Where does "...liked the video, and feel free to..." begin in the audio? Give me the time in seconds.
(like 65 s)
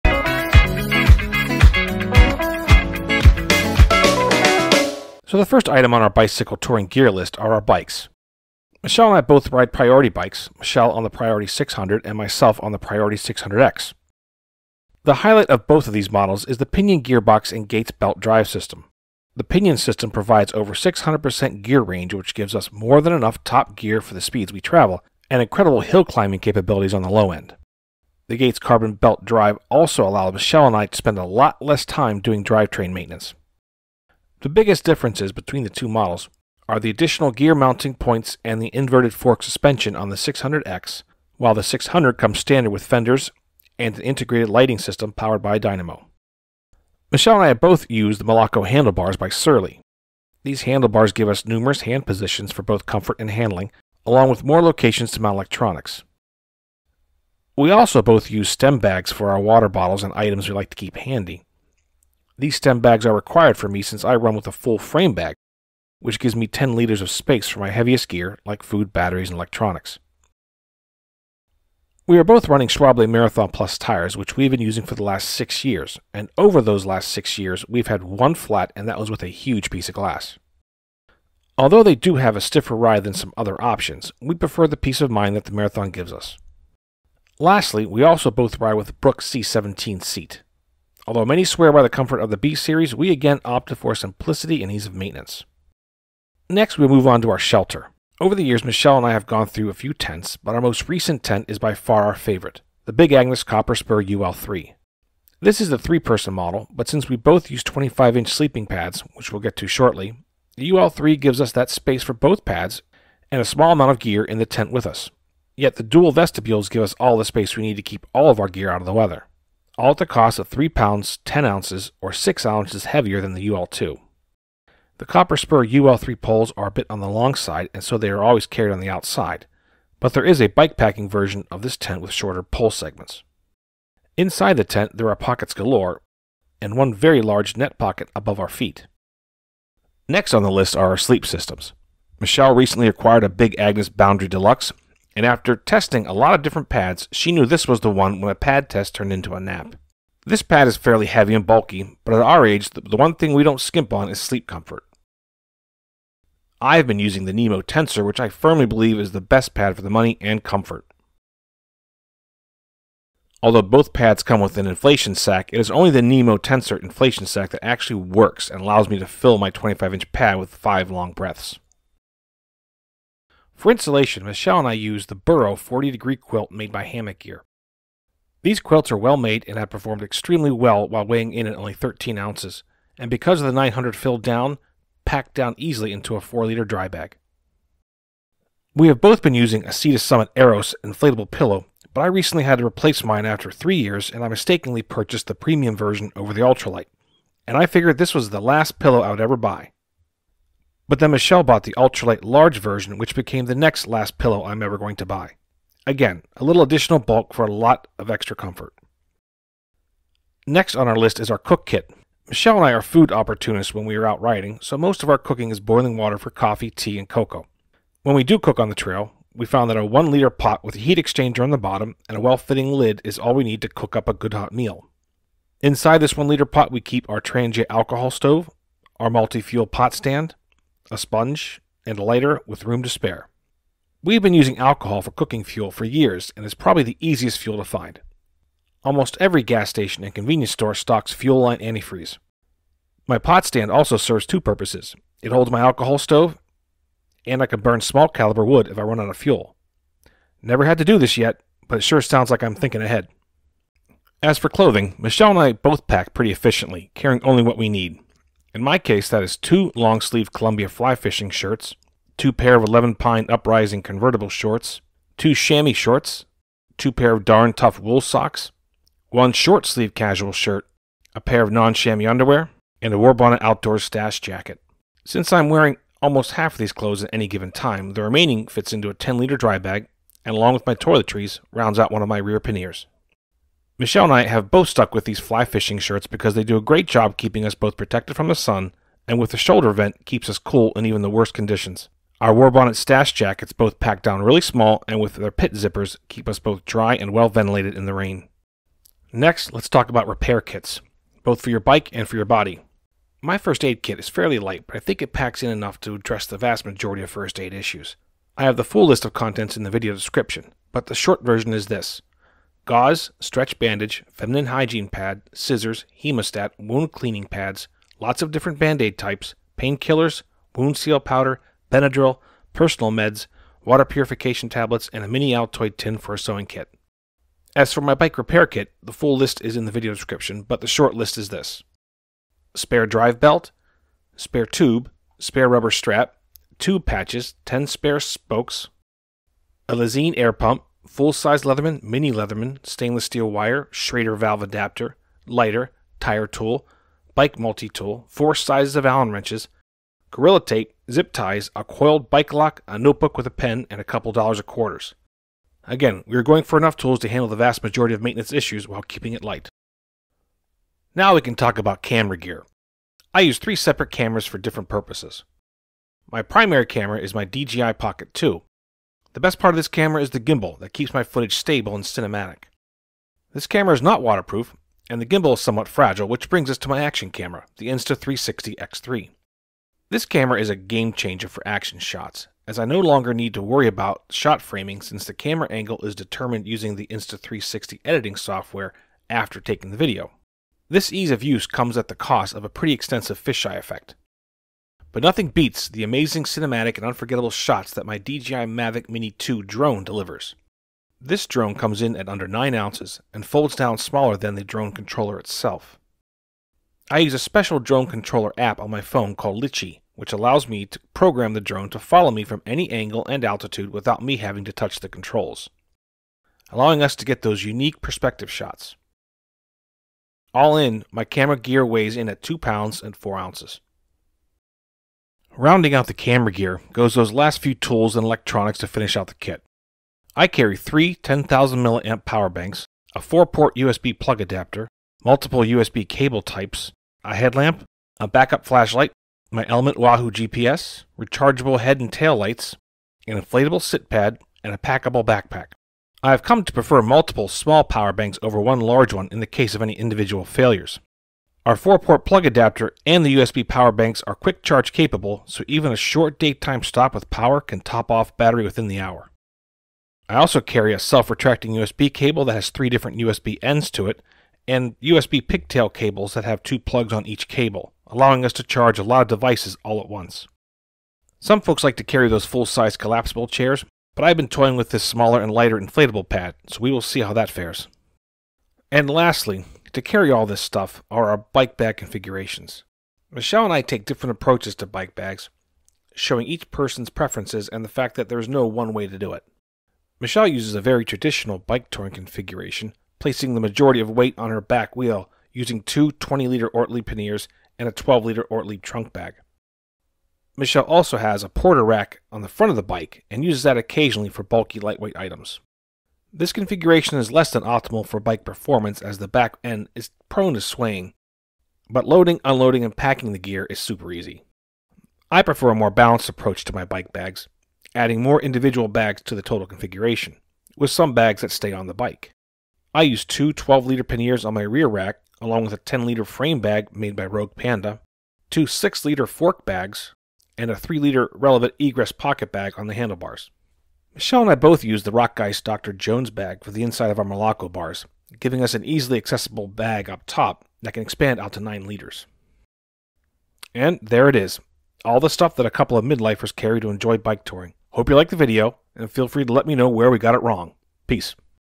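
547 s.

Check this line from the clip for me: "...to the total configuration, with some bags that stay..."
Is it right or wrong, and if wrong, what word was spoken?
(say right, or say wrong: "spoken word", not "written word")
right.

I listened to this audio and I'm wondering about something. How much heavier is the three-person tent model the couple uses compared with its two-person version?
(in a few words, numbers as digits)
6 ounces.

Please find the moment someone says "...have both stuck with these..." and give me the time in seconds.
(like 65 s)
284 s.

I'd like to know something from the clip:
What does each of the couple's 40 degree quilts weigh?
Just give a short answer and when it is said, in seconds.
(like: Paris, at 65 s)
13 ounces, at 181 s.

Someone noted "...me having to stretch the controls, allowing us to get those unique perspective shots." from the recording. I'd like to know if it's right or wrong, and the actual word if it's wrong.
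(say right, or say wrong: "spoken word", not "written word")
wrong: "touch", not "stretch".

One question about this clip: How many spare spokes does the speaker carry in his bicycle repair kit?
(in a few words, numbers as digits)
10.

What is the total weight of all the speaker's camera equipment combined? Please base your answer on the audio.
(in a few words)
2 pounds 4 ounces.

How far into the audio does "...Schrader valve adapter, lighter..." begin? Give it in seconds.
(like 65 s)
343 s.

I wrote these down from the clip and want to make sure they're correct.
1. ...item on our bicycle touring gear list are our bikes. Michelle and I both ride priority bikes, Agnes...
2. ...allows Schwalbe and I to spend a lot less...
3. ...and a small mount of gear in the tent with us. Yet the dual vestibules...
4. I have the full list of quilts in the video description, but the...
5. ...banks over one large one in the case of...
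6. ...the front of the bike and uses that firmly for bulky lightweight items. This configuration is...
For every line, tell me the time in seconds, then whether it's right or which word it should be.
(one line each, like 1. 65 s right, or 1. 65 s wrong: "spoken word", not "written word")
1. 5 s wrong: "Michelle", not "Agnes"
2. 30 s wrong: "Michelle", not "Schwalbe"
3. 113 s wrong: "amount", not "mount"
4. 308 s wrong: "contents", not "quilts"
5. 447 s right
6. 502 s wrong: "occasionally", not "firmly".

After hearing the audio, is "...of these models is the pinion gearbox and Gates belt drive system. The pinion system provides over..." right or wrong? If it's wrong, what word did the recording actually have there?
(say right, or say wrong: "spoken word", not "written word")
right.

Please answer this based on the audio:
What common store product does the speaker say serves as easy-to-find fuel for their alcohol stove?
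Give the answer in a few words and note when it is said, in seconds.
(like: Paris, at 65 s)
fuel line antifreeze, at 241 s.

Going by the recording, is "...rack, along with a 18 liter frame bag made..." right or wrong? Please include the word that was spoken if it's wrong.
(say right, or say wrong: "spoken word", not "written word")
wrong: "10", not "18".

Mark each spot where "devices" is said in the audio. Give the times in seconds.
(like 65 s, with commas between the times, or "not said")
469 s.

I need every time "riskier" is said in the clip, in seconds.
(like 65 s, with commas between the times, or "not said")
not said.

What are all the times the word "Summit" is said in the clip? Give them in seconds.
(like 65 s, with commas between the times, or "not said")
189 s.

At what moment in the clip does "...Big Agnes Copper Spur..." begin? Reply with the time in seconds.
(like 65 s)
102 s.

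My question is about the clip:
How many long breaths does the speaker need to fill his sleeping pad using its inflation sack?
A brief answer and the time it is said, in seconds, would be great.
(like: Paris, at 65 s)
5, at 170 s.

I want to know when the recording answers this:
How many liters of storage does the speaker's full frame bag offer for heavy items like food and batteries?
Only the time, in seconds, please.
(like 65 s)
66 s.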